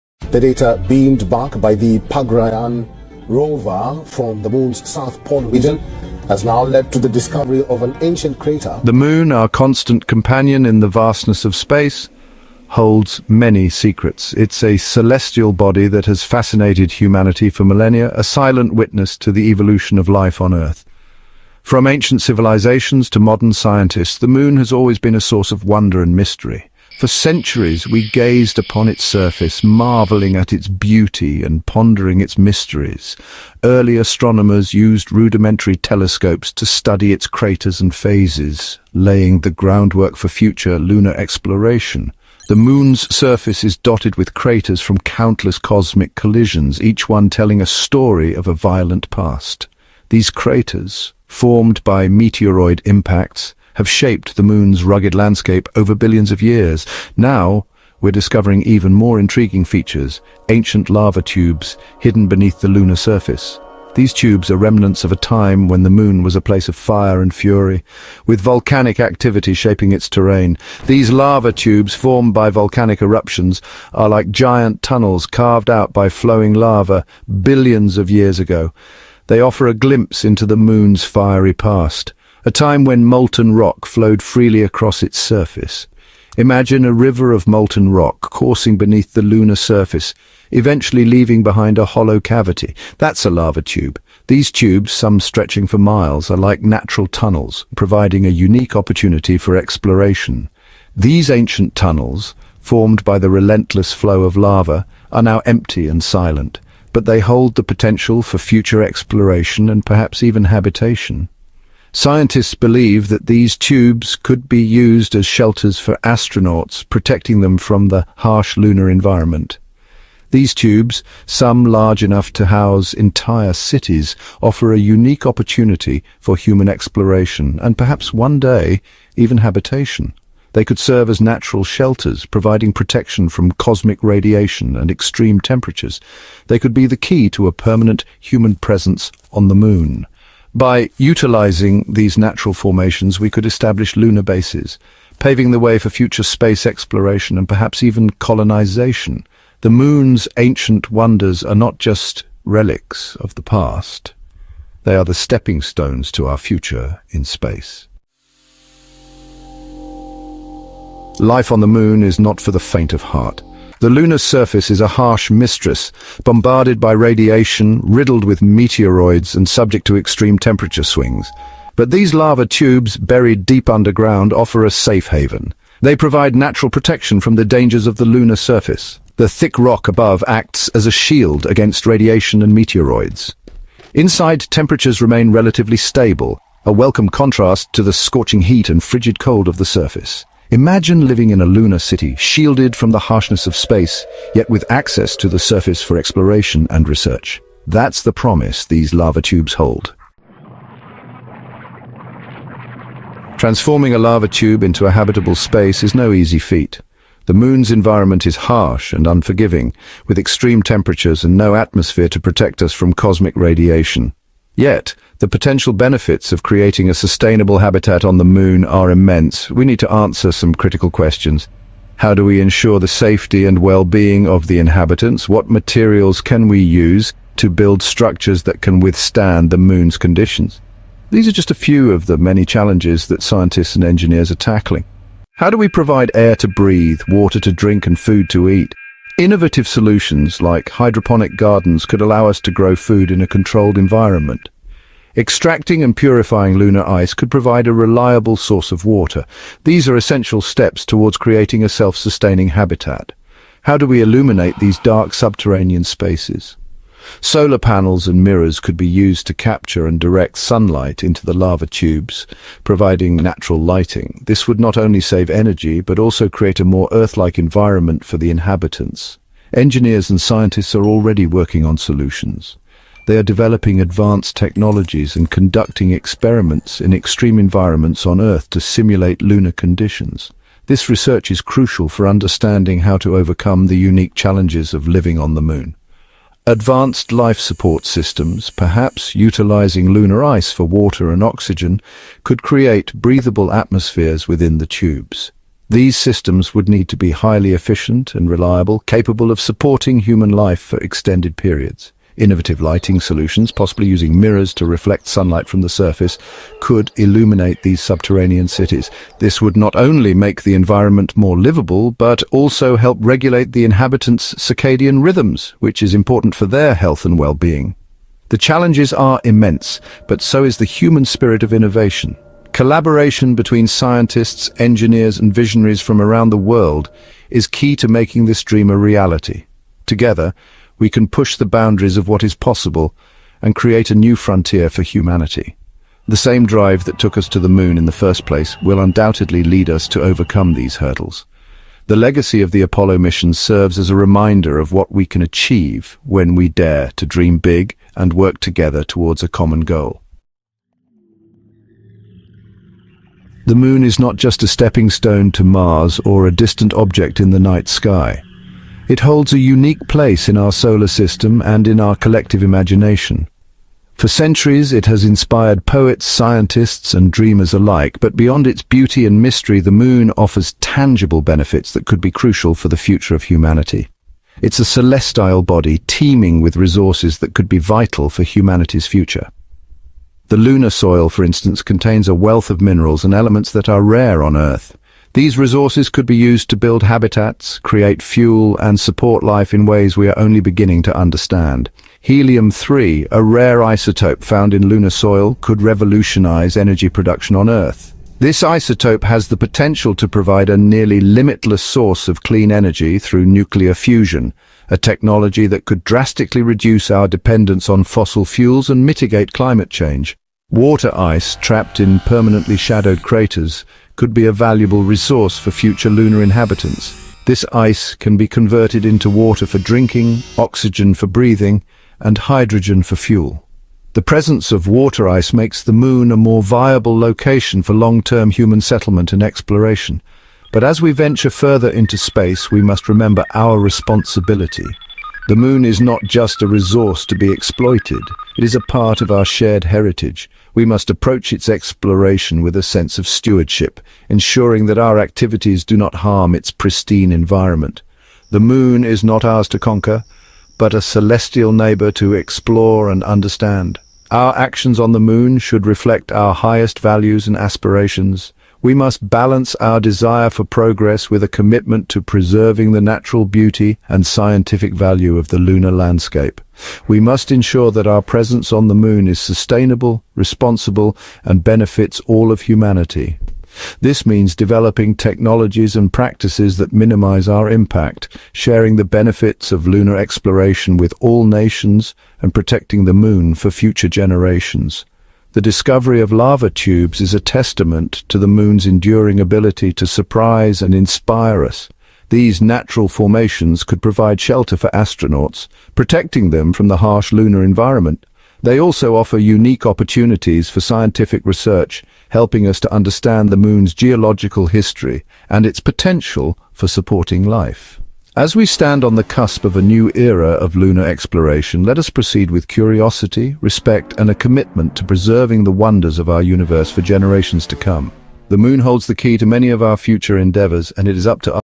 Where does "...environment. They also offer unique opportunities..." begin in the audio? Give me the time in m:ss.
8:17.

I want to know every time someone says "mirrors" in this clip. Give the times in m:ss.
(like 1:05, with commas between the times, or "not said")
4:18, 5:04.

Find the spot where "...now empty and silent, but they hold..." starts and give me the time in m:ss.
1:45.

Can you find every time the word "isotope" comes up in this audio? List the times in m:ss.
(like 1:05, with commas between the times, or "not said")
6:33, 6:38.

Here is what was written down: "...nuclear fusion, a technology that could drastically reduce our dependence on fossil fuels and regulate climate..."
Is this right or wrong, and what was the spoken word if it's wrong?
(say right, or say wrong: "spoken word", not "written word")
wrong: "mitigate", not "regulate".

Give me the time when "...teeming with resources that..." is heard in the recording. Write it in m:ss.
6:15.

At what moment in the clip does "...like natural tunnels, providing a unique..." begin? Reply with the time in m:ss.
1:36.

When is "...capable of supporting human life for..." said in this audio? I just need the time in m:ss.
4:58.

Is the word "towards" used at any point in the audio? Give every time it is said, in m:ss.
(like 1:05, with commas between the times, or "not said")
4:10, 5:48.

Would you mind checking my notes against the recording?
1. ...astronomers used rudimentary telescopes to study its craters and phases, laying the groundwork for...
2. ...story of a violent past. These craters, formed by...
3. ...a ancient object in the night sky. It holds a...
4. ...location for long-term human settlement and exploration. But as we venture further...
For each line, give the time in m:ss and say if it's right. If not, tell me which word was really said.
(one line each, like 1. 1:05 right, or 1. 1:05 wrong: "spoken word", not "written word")
1. 0:33 right
2. 0:47 right
3. 5:56 wrong: "distant", not "ancient"
4. 7:06 right.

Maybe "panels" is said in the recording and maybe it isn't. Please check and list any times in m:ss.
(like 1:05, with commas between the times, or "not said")
4:17.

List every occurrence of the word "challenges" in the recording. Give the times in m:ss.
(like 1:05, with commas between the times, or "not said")
3:52, 4:44, 5:18.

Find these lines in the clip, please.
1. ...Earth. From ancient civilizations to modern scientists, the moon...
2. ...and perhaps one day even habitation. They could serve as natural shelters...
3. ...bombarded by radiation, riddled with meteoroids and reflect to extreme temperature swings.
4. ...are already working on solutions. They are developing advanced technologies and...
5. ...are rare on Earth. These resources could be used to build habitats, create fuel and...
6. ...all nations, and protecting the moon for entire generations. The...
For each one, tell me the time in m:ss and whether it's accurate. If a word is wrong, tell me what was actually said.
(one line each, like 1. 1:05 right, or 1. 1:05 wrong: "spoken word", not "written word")
1. 0:20 right
2. 2:07 right
3. 2:46 wrong: "subject", not "reflect"
4. 4:30 right
5. 6:23 right
6. 8:01 wrong: "future", not "entire".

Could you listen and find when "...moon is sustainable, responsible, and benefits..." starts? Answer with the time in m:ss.
7:48.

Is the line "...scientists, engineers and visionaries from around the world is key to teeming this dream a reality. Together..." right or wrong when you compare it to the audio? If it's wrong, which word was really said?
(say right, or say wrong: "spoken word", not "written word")
wrong: "making", not "teeming".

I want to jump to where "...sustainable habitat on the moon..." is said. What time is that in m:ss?
3:36.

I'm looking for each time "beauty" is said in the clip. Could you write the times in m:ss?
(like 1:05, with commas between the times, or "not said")
0:30, 6:08, 7:43.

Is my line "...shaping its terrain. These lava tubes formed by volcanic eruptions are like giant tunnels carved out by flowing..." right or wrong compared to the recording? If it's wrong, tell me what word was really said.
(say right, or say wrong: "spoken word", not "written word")
right.